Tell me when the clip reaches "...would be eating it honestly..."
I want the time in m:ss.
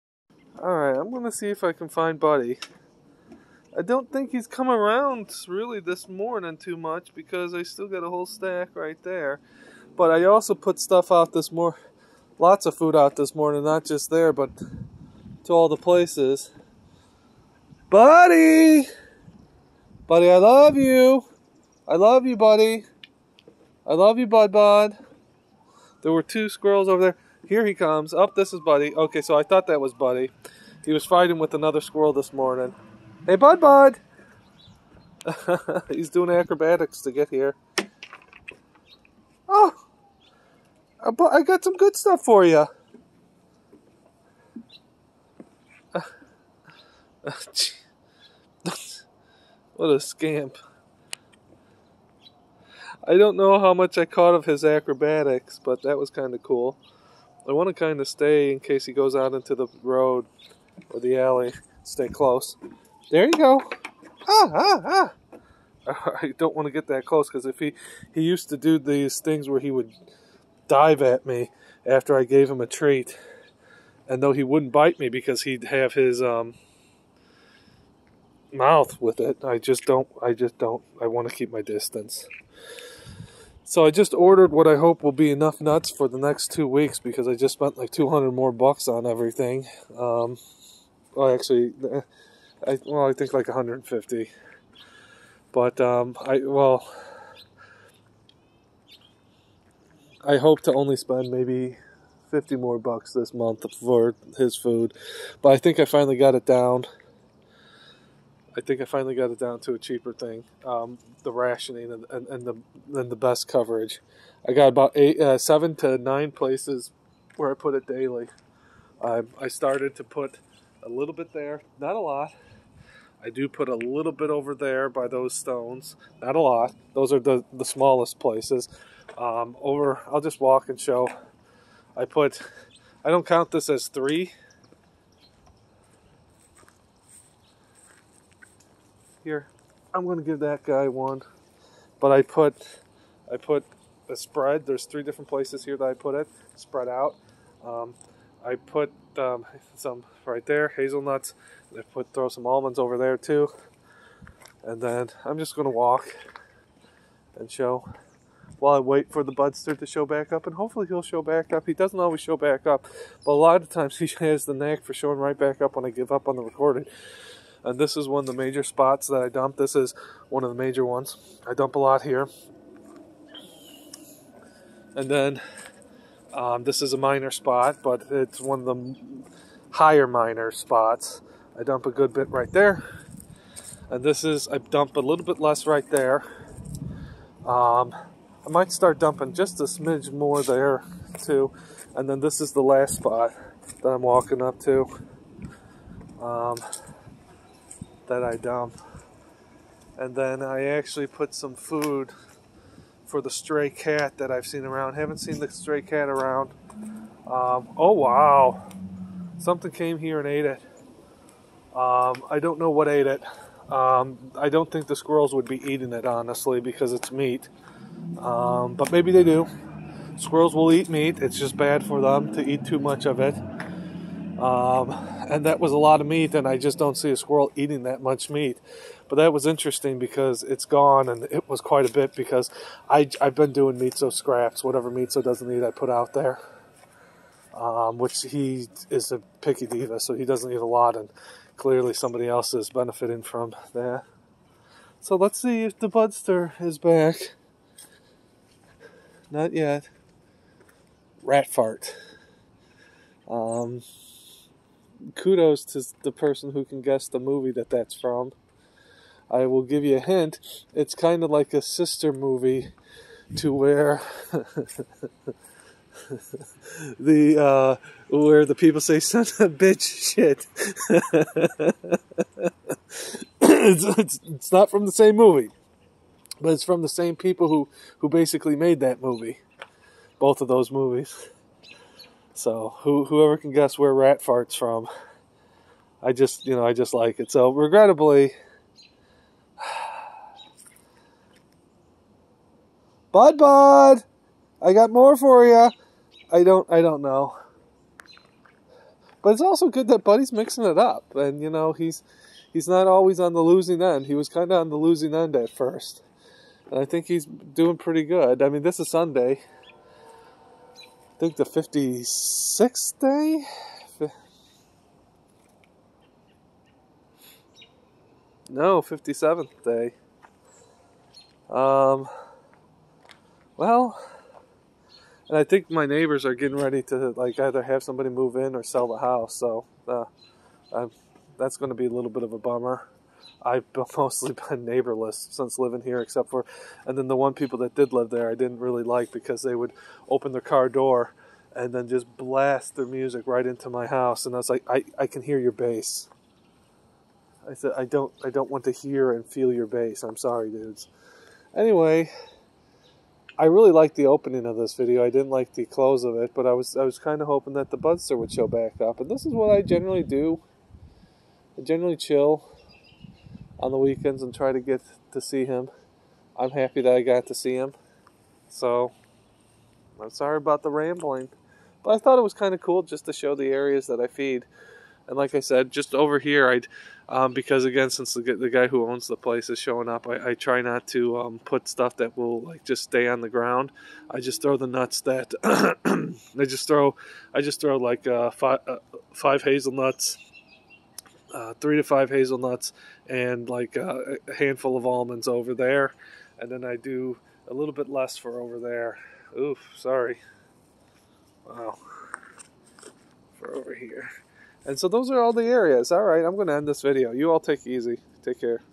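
3:35.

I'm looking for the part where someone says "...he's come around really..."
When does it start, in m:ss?
0:04.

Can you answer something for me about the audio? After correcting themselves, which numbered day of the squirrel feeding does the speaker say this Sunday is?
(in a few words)
57th.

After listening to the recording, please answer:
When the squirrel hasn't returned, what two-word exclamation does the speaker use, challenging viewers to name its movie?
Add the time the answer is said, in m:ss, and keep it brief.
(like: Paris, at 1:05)
Rat fart, at 4:11.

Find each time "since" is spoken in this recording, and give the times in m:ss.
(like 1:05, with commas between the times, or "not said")
5:35, 6:17.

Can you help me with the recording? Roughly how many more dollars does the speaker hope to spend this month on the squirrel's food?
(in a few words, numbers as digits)
50.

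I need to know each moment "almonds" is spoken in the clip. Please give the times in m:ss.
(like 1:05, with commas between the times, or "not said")
2:32, 6:34.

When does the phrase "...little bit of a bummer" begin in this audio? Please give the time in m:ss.
5:31.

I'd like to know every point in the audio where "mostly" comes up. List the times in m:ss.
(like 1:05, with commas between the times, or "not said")
5:33.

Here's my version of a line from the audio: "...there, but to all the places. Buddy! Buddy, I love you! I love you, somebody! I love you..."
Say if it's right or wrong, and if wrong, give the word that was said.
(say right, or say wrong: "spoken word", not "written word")
wrong: "buddy", not "somebody".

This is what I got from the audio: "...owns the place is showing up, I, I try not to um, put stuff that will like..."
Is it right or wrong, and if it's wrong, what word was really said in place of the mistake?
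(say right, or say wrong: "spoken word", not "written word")
right.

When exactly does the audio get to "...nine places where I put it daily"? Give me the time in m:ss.
1:55.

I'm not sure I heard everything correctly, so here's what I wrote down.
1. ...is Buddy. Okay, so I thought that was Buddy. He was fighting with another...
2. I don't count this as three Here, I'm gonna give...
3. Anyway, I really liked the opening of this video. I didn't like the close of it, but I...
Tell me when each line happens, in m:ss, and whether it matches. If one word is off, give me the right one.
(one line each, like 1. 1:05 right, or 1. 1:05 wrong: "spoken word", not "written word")
1. 0:28 right
2. 2:13 right
3. 5:51 right.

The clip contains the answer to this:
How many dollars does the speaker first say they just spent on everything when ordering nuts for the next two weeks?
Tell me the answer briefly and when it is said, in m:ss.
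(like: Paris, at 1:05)
200, at 1:27.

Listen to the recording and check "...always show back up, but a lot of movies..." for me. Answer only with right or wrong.
wrong.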